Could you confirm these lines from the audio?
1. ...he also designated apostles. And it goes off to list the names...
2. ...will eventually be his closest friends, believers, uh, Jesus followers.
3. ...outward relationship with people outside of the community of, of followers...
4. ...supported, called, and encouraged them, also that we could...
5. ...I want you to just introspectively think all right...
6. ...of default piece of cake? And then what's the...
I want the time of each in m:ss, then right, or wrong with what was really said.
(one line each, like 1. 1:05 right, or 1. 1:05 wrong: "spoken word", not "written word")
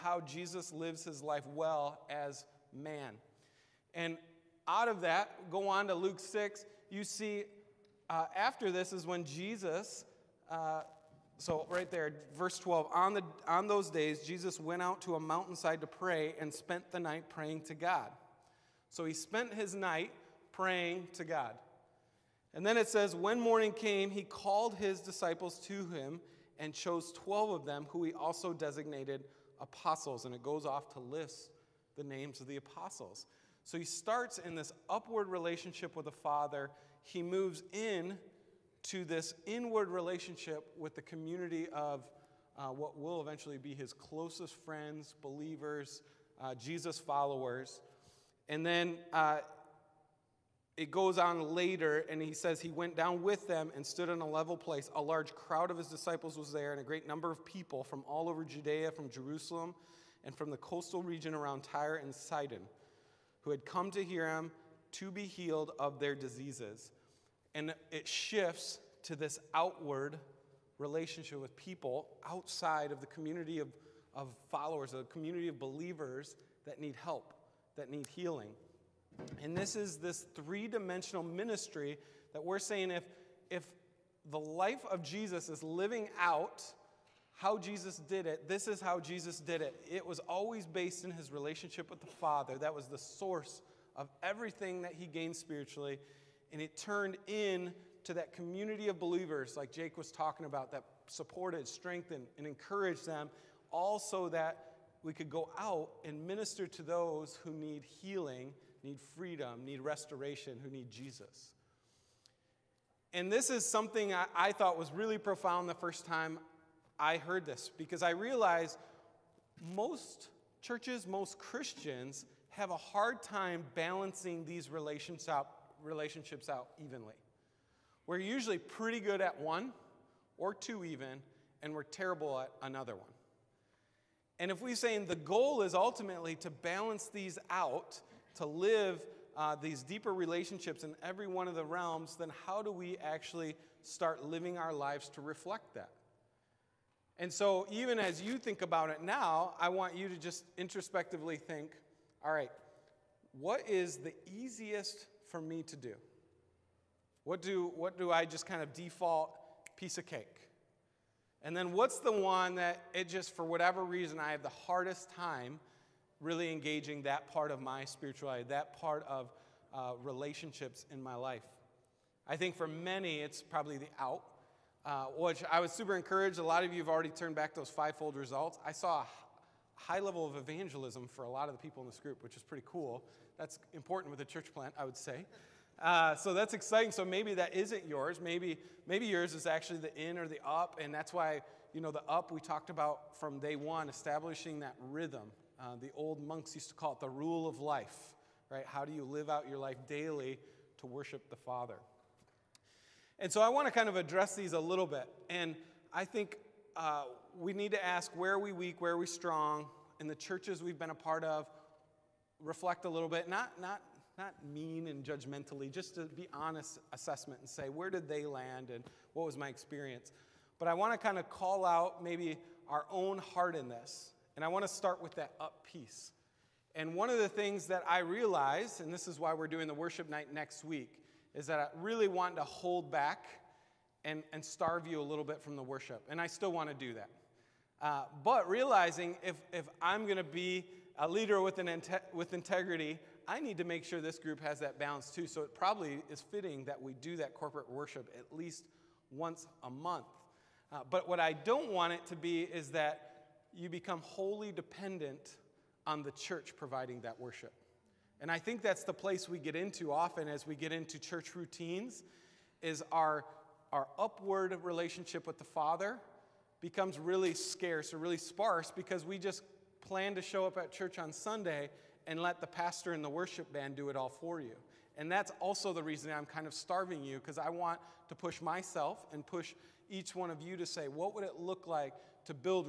1. 0:28 right
2. 0:42 right
3. 1:09 right
4. 1:41 wrong: "strengthened", not "called"
5. 2:29 right
6. 2:38 right.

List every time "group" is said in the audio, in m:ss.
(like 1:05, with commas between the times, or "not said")
3:01, 4:04.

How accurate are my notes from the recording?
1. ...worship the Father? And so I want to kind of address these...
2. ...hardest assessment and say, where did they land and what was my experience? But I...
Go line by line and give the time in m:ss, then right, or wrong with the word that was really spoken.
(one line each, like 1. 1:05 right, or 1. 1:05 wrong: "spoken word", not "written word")
1. 3:20 right
2. 3:36 wrong: "honest", not "hardest".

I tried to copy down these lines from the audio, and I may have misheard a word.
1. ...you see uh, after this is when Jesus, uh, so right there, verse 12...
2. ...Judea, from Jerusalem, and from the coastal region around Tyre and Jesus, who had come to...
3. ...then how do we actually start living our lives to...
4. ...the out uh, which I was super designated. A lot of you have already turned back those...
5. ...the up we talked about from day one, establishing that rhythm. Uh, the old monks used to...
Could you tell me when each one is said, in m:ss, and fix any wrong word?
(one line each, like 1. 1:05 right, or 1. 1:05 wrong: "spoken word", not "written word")
1. 0:06 right
2. 0:58 wrong: "Sidon", not "Jesus"
3. 2:22 right
4. 2:53 wrong: "encouraged", not "designated"
5. 3:11 right.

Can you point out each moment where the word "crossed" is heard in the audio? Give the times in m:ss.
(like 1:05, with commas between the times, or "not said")
not said.